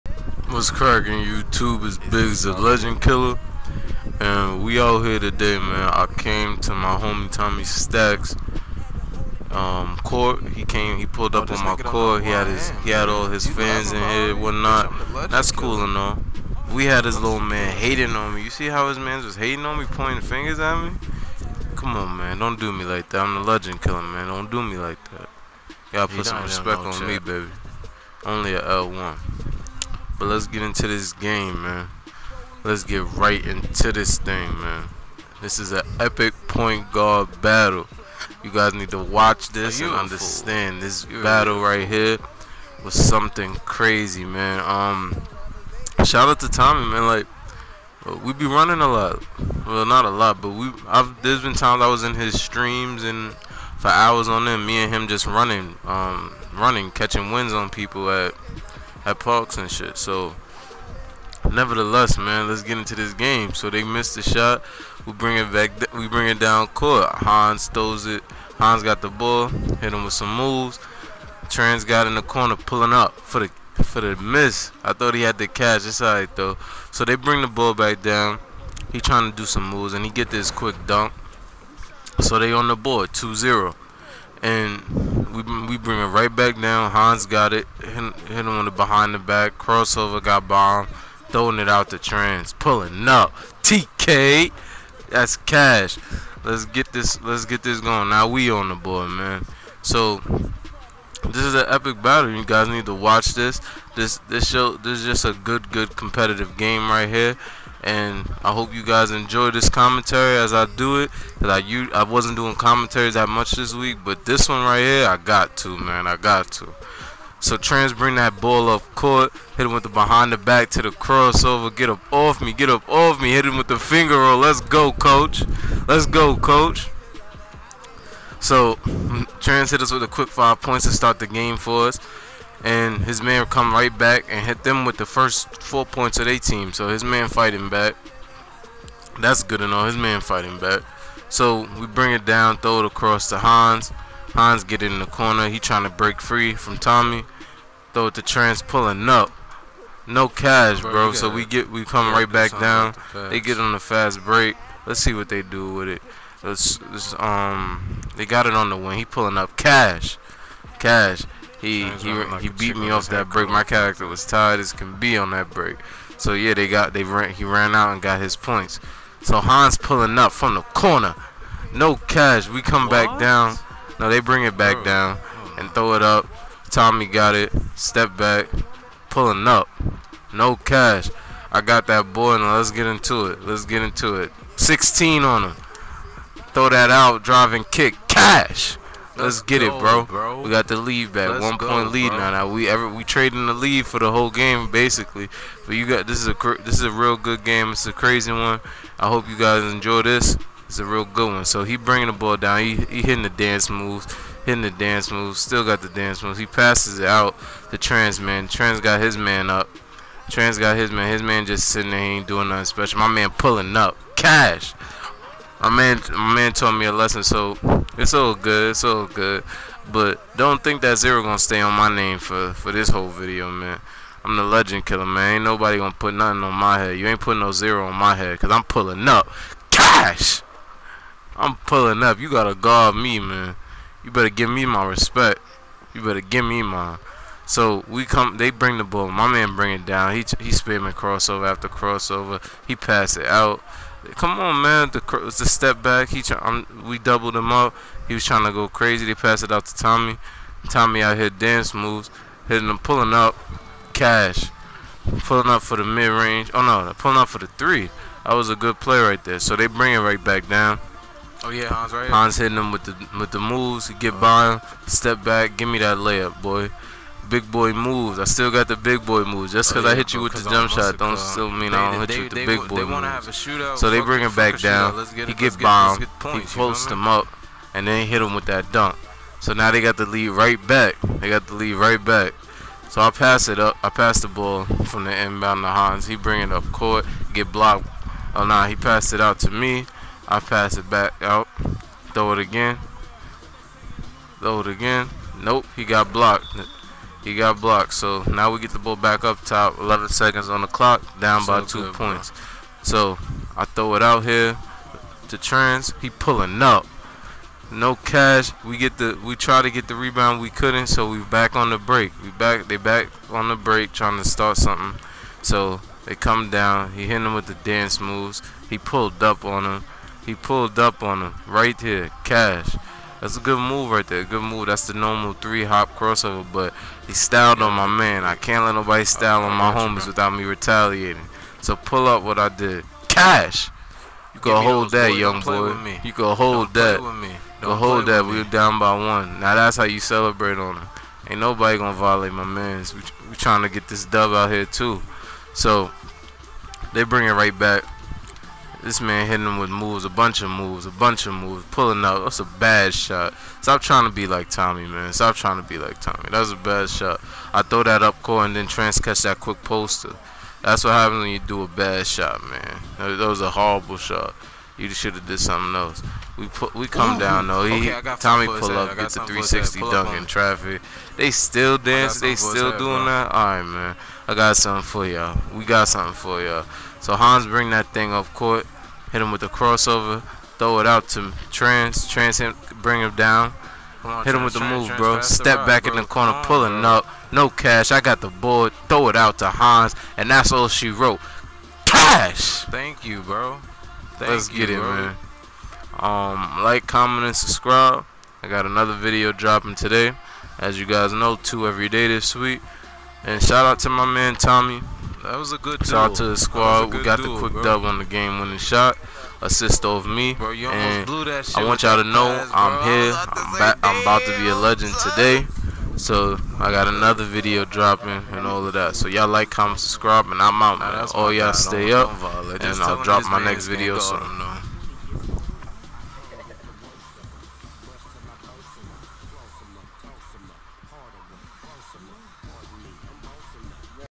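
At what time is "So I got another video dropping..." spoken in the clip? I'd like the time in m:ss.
6:56.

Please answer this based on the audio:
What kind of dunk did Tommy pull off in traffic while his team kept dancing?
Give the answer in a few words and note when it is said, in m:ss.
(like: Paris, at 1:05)
360 dunk, at 6:09.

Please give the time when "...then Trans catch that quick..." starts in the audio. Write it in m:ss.
5:58.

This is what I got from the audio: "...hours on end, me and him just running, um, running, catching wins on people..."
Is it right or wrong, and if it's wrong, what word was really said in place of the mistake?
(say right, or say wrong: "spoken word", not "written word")
right.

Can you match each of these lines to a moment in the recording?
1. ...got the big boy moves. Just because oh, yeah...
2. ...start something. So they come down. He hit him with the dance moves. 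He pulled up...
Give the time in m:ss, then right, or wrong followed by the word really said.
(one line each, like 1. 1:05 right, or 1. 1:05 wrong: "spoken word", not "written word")
1. 4:28 right
2. 5:14 right.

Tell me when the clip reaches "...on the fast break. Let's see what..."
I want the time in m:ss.
2:33.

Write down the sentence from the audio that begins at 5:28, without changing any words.
I can't let nobody style on my homies without me retaliating.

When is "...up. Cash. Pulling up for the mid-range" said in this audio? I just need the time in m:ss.
4:13.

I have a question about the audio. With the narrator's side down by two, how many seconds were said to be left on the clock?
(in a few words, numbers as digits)
11.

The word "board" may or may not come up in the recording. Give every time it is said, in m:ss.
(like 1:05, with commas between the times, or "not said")
1:22, 1:38, 6:28.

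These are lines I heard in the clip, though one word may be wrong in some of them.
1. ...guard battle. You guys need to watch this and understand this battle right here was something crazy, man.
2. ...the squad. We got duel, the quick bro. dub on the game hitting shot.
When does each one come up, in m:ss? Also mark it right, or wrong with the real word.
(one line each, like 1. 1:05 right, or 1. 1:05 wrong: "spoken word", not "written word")
1. 0:36 right
2. 6:46 wrong: "winning", not "hitting".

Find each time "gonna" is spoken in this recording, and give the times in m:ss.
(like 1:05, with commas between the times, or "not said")
3:41, 3:45, 5:41.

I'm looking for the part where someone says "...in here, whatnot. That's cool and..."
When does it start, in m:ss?
0:13.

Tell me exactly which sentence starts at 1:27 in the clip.
Hit, hit him on the behind the back.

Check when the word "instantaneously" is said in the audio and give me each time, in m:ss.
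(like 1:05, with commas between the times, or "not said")
not said.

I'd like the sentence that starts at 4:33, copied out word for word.
Shootout, so they bring him back down.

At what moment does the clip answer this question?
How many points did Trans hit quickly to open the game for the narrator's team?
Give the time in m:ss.
2:10.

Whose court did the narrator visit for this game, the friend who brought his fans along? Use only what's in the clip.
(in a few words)
Tommy Stacks.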